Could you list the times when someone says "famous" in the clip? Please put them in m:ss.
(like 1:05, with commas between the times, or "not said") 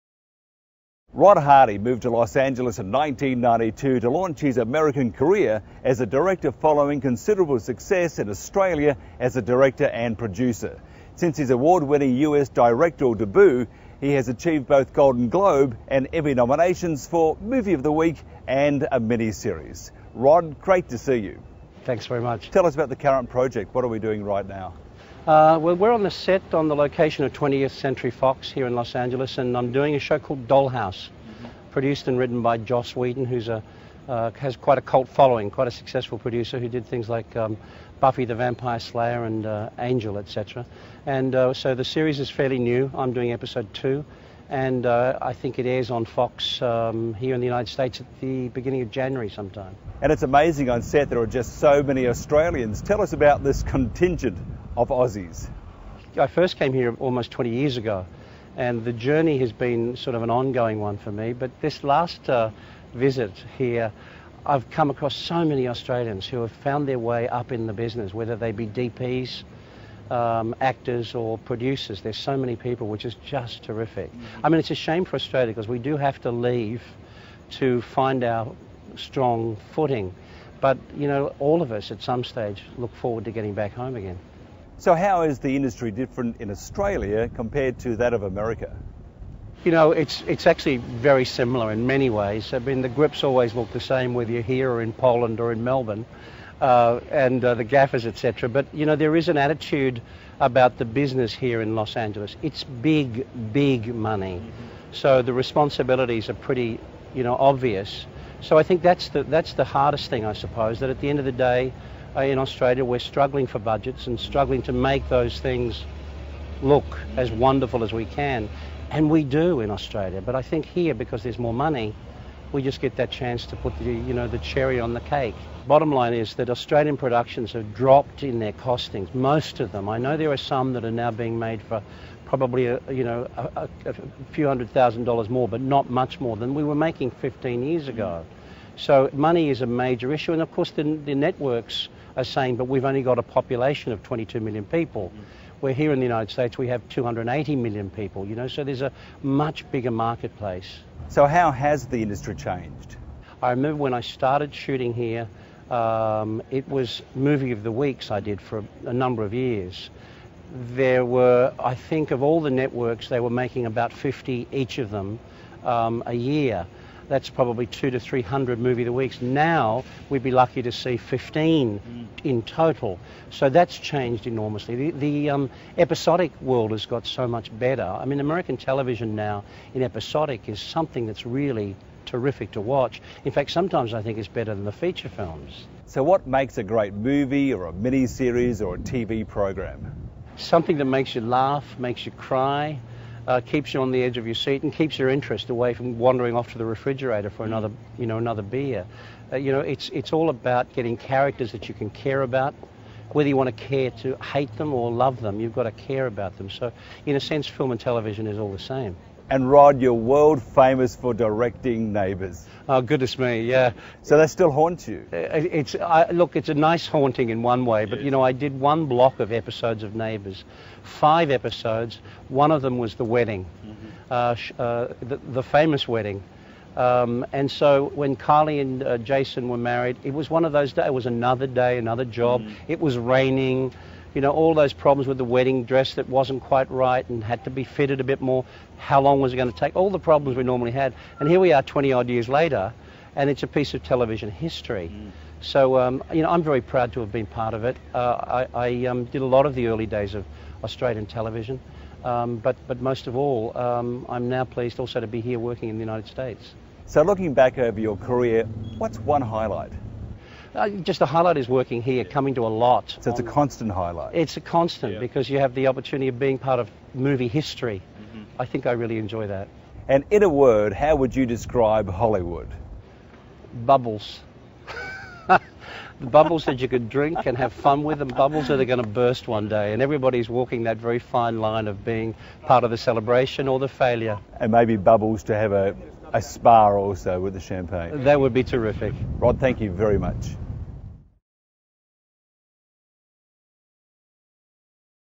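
3:30, 3:45.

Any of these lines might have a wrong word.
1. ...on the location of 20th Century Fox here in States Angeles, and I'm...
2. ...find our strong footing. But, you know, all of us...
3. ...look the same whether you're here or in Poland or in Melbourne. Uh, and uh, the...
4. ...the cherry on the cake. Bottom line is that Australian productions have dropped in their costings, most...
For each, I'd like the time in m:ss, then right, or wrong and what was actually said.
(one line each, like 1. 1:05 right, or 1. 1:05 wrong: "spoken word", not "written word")
1. 0:26 wrong: "Los", not "States"
2. 1:17 right
3. 1:33 right
4. 2:04 right.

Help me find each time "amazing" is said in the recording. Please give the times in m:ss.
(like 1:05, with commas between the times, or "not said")
0:50.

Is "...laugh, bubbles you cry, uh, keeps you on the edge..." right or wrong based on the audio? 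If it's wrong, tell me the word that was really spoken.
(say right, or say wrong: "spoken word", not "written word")
wrong: "makes", not "bubbles".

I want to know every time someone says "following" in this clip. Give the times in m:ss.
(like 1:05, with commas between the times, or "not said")
0:06, 0:35.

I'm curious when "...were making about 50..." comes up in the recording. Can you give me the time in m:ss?
2:43.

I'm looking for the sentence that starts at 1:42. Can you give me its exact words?
It's big, big money, so the responsibilities are pretty, you know, obvious.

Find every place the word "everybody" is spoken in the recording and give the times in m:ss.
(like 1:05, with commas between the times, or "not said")
4:39.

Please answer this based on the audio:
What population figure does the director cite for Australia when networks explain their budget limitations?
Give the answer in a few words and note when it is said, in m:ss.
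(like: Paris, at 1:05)
22 million, at 2:24.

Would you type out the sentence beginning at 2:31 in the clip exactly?
So how has the industry changed?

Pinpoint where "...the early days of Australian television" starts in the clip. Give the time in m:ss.
4:09.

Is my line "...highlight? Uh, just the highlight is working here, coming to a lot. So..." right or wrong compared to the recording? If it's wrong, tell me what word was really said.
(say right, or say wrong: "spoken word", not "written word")
right.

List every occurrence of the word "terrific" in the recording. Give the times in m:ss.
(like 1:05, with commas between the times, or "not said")
1:13, 3:02, 4:48.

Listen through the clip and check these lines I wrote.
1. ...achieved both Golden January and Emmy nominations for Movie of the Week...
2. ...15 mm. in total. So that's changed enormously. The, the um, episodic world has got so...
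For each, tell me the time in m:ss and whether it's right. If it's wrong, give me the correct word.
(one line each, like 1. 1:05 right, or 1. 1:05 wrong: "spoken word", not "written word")
1. 0:14 wrong: "Globe", not "January"
2. 2:50 right.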